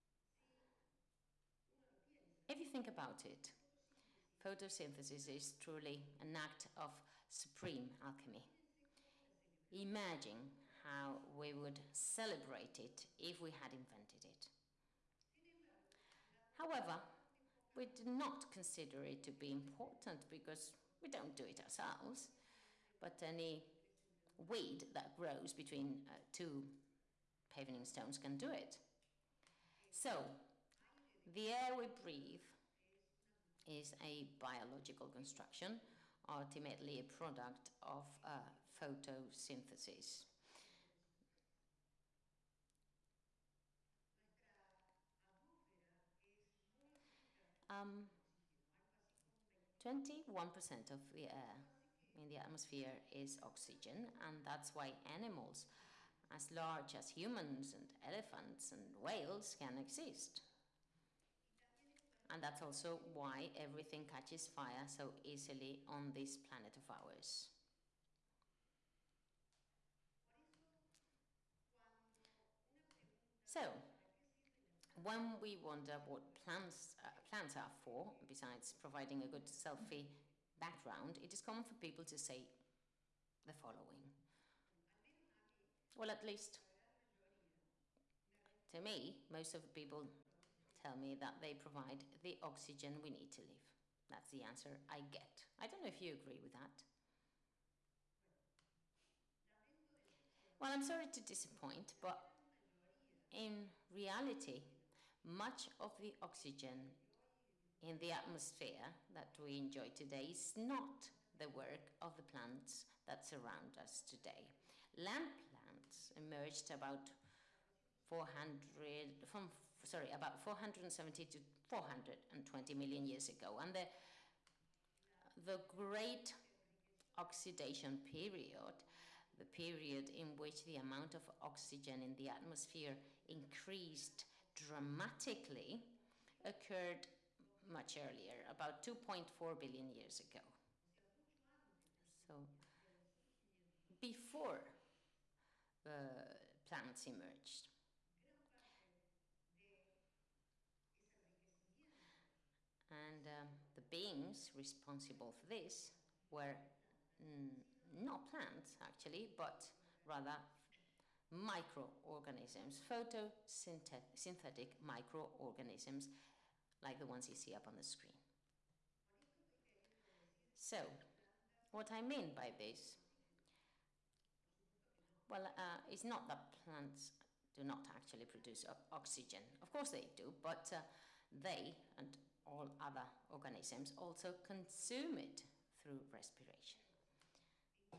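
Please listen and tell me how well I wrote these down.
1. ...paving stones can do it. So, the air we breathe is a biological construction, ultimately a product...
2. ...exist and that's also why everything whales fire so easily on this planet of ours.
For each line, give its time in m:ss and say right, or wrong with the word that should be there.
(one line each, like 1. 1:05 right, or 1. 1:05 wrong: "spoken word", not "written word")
1. 0:27 right
2. 0:59 wrong: "catches", not "whales".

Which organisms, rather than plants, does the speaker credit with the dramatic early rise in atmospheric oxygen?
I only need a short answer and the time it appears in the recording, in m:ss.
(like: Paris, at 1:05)
Photosynthetic microorganisms, at 2:42.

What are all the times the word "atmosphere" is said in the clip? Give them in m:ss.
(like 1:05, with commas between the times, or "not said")
0:52, 1:48, 2:12.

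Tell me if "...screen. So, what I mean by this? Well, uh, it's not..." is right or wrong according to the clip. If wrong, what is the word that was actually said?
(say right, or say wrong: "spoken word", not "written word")
right.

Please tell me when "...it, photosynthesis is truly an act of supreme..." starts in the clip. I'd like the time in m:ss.
0:03.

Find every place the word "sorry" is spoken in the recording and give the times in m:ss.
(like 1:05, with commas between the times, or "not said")
1:40, 1:59.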